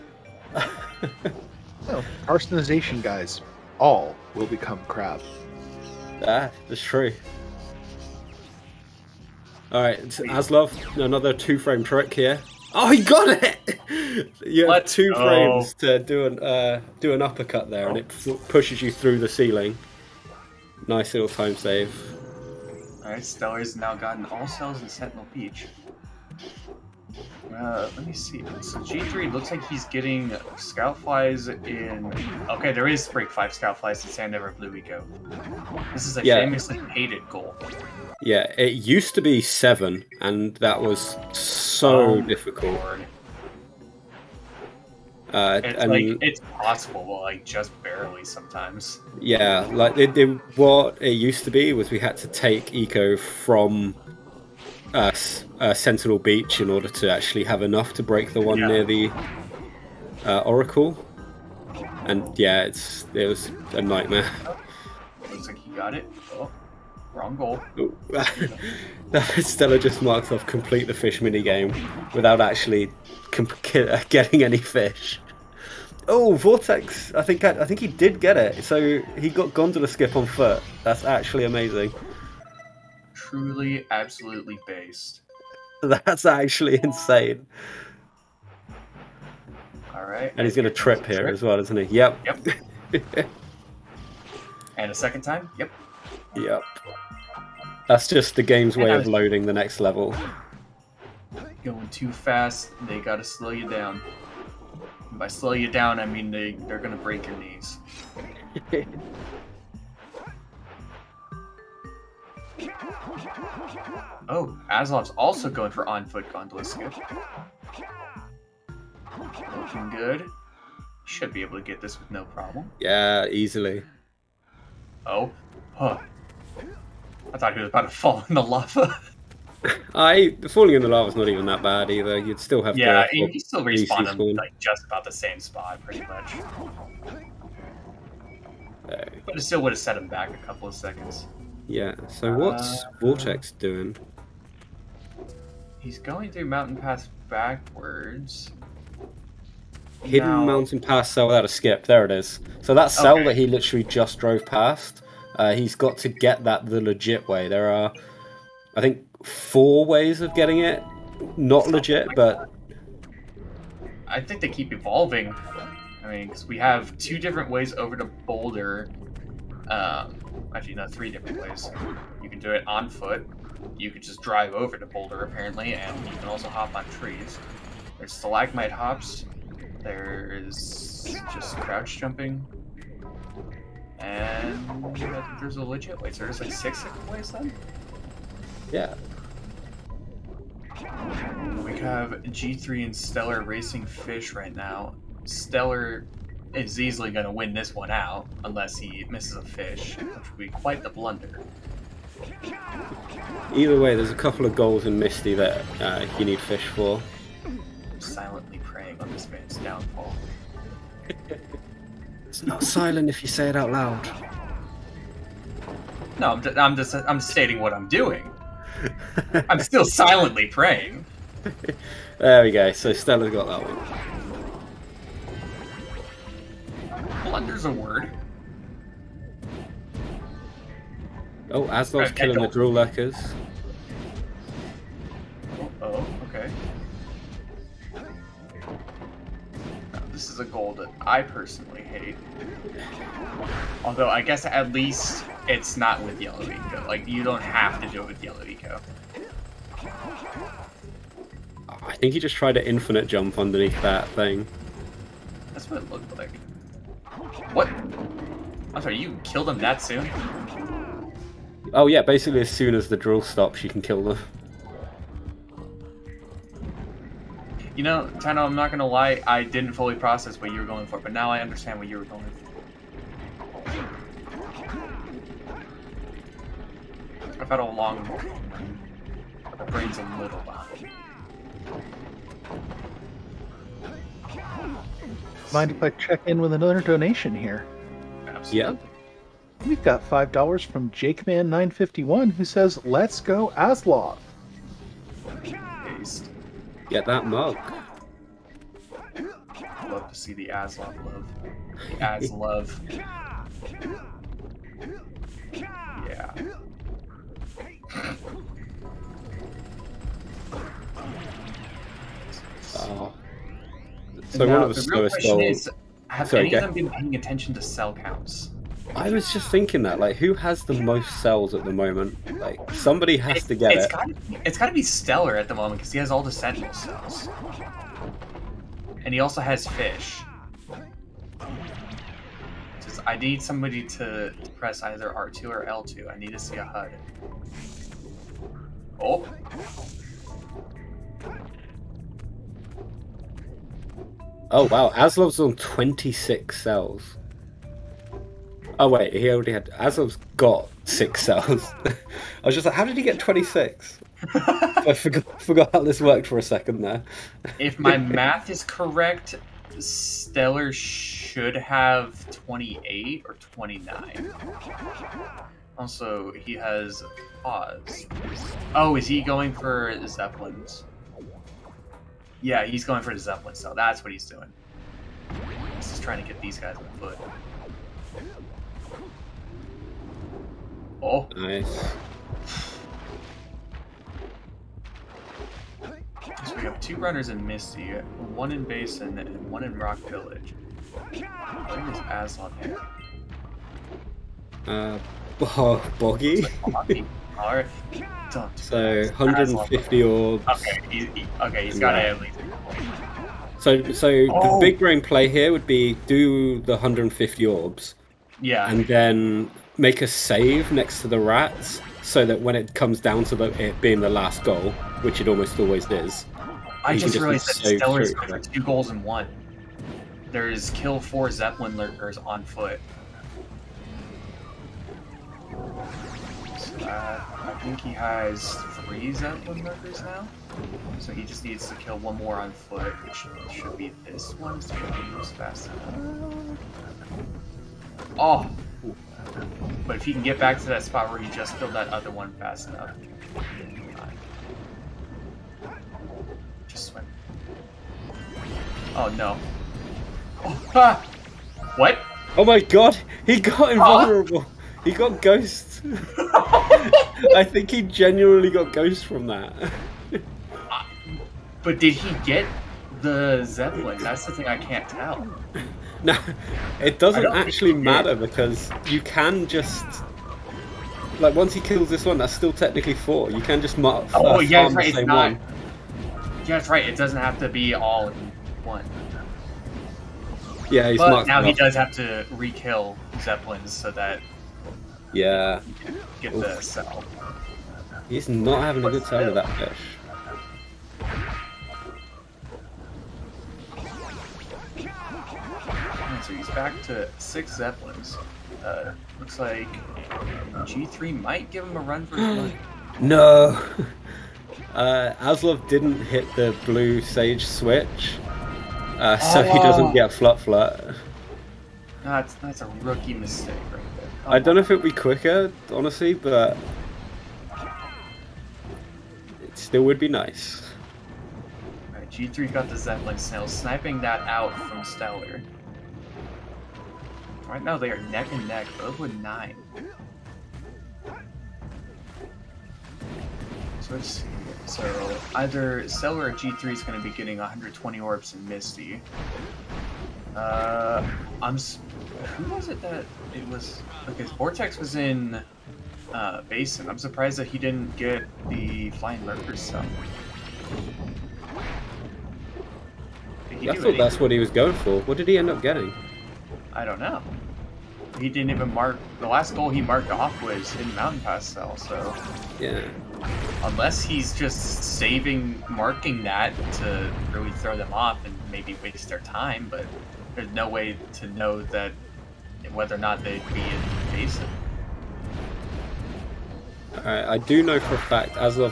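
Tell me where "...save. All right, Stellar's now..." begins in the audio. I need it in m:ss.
0:21.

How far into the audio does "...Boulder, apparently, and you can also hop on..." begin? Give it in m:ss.
2:54.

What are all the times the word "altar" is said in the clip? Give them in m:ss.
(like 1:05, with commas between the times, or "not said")
not said.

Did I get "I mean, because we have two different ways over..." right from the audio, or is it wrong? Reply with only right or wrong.
right.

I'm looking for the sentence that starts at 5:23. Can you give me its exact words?
Gotta, it's got to be Stellar at the moment because he has all the central cells, and he also has fish.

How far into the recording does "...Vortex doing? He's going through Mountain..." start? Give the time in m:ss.
2:22.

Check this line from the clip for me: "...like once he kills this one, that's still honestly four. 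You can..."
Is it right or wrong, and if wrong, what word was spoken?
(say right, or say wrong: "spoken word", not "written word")
wrong: "technically", not "honestly".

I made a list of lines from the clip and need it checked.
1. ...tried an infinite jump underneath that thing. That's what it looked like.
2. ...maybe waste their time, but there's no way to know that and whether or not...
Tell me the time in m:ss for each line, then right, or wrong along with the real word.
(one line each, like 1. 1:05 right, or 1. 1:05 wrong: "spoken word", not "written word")
1. 4:12 right
2. 9:28 right.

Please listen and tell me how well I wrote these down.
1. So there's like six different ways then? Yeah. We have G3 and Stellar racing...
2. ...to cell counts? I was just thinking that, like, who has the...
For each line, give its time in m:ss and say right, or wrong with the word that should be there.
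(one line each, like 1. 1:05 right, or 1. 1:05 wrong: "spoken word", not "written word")
1. 3:06 right
2. 5:17 right.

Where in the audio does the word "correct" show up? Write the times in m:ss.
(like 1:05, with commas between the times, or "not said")
5:58.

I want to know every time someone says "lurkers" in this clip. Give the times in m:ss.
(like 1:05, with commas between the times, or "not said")
3:52, 7:01, 9:09.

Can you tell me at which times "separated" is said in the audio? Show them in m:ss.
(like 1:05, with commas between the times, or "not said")
not said.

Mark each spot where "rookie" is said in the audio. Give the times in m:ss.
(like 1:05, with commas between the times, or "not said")
8:32.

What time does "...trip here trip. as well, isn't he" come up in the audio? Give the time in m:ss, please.
1:30.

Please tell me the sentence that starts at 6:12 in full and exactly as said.
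Yeah, he's going for the Zeppelin So That's what he's doing.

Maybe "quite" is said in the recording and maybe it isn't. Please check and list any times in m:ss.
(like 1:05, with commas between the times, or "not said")
3:20.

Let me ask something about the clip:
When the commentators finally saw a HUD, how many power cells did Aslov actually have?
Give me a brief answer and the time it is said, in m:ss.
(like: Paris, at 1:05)
6, at 5:50.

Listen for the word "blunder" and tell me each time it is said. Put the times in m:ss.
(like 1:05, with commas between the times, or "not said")
3:20, 3:47.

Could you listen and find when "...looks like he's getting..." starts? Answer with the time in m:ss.
0:29.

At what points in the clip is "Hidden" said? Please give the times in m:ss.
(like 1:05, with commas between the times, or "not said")
2:30.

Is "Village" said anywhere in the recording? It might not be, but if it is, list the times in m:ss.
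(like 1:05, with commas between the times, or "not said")
6:30.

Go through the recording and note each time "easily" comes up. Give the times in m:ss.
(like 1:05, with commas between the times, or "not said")
2:03, 3:16.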